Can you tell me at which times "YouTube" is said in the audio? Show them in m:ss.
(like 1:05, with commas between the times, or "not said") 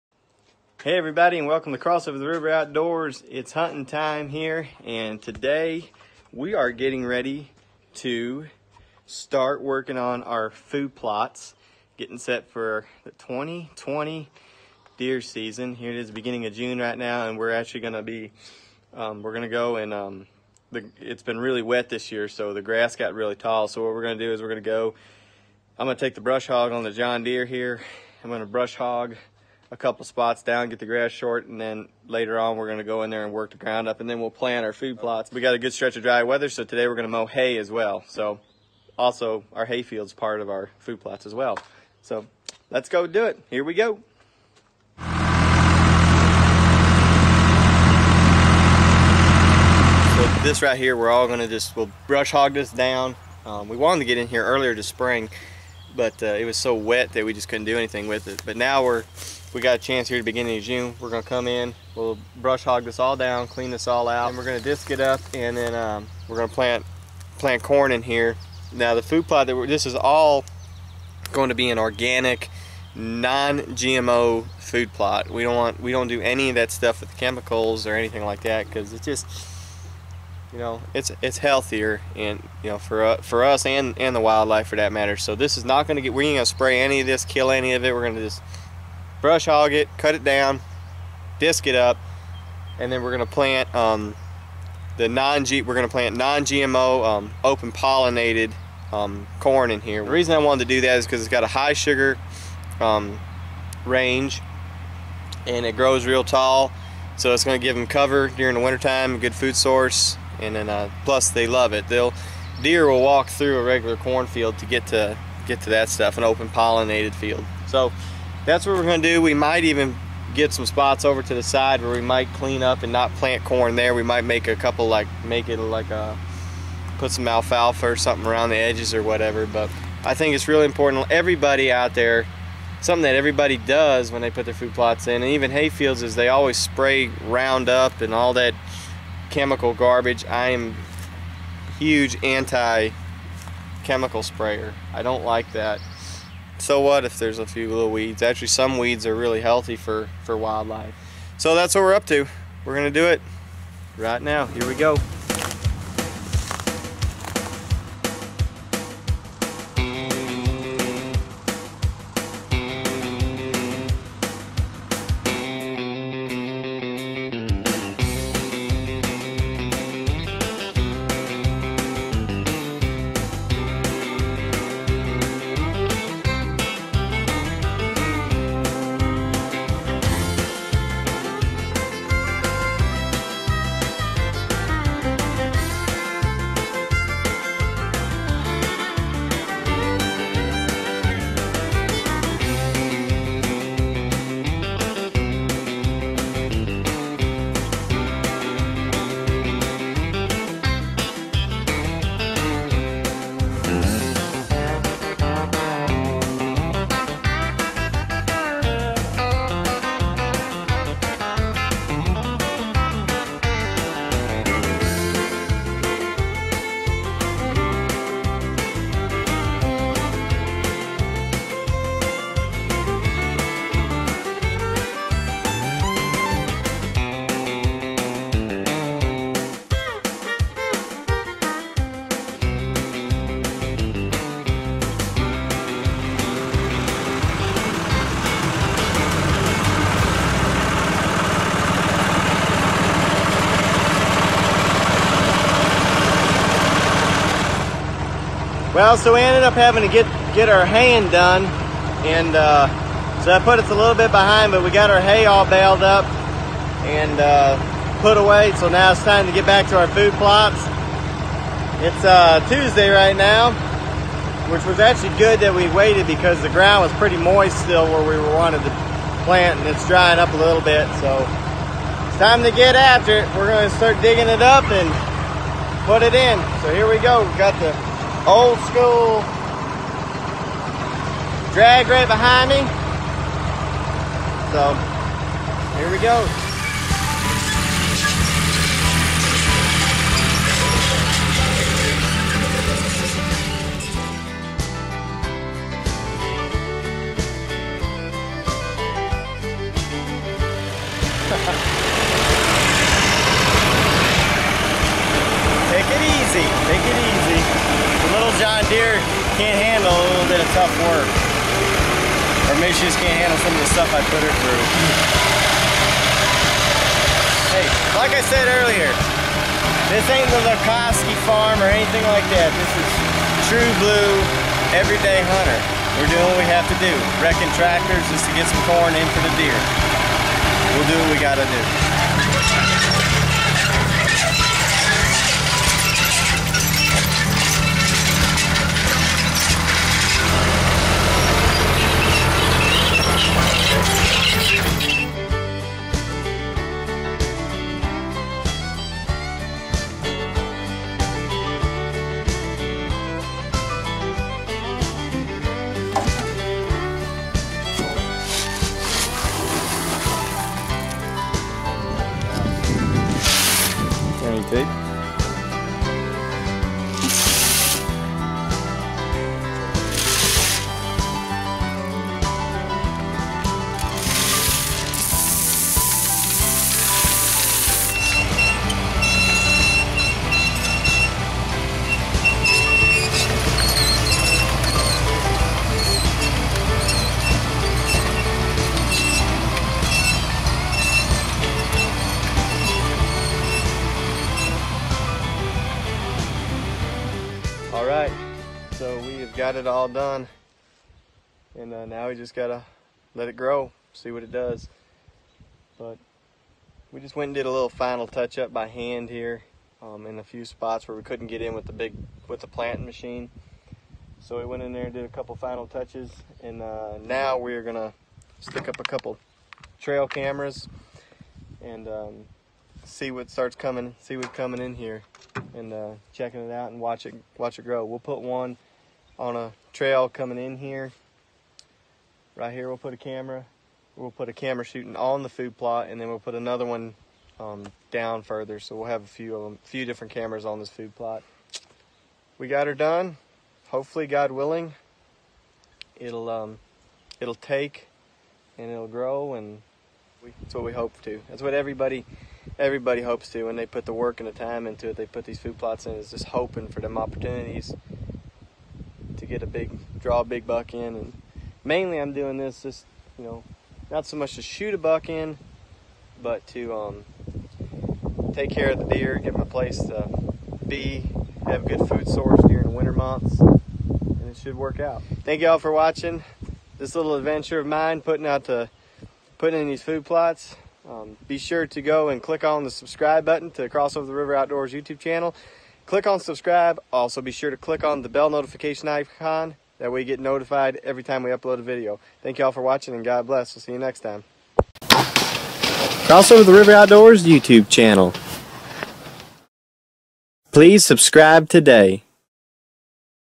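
8:04, 8:17.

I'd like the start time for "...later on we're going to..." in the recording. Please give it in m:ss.
0:32.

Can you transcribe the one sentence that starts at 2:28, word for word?
Actually, some weeds are really healthy for, for wildlife.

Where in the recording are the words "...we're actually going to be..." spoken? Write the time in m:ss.
0:17.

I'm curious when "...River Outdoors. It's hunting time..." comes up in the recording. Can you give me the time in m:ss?
0:02.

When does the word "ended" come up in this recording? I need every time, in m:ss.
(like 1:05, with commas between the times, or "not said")
4:09.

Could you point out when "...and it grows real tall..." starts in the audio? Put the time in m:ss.
1:45.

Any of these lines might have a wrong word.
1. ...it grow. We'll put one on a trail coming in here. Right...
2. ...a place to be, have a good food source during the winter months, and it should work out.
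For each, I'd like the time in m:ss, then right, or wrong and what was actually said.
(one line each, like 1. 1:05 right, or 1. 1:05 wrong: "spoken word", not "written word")
1. 7:07 right
2. 7:49 right.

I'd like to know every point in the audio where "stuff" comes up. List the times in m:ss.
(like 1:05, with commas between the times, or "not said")
1:16, 1:55, 5:13.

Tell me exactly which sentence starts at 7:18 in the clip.
So we'll have a few of them, few different cameras on this food plot.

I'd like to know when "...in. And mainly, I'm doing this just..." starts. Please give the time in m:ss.
7:40.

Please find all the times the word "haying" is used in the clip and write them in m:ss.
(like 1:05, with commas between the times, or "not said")
4:10.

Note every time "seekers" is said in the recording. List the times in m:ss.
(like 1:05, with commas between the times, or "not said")
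not said.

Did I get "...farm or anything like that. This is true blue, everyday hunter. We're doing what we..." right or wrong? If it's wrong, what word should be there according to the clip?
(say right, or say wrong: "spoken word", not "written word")
right.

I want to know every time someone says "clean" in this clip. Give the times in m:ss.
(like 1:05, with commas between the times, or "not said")
1:03, 2:02.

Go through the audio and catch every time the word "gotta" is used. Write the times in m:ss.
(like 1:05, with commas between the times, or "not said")
5:31, 6:42.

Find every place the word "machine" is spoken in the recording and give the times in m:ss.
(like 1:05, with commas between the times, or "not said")
6:52.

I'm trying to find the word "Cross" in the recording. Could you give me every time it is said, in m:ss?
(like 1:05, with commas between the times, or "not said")
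0:01, 8:03, 8:16.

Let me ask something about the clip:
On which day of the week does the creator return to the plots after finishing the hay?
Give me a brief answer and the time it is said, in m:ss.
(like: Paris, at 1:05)
Tuesday, at 4:22.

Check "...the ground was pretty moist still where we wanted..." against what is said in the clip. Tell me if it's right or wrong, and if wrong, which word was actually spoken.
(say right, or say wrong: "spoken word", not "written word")
right.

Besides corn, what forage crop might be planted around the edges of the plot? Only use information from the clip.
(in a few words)
Alfalfa.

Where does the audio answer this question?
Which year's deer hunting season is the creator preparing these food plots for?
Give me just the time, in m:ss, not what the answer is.
0:13.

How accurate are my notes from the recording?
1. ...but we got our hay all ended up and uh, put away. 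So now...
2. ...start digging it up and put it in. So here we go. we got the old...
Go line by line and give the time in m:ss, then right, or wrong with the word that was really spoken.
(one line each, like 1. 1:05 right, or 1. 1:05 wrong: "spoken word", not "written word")
1. 4:14 wrong: "baled", not "ended"
2. 4:33 right.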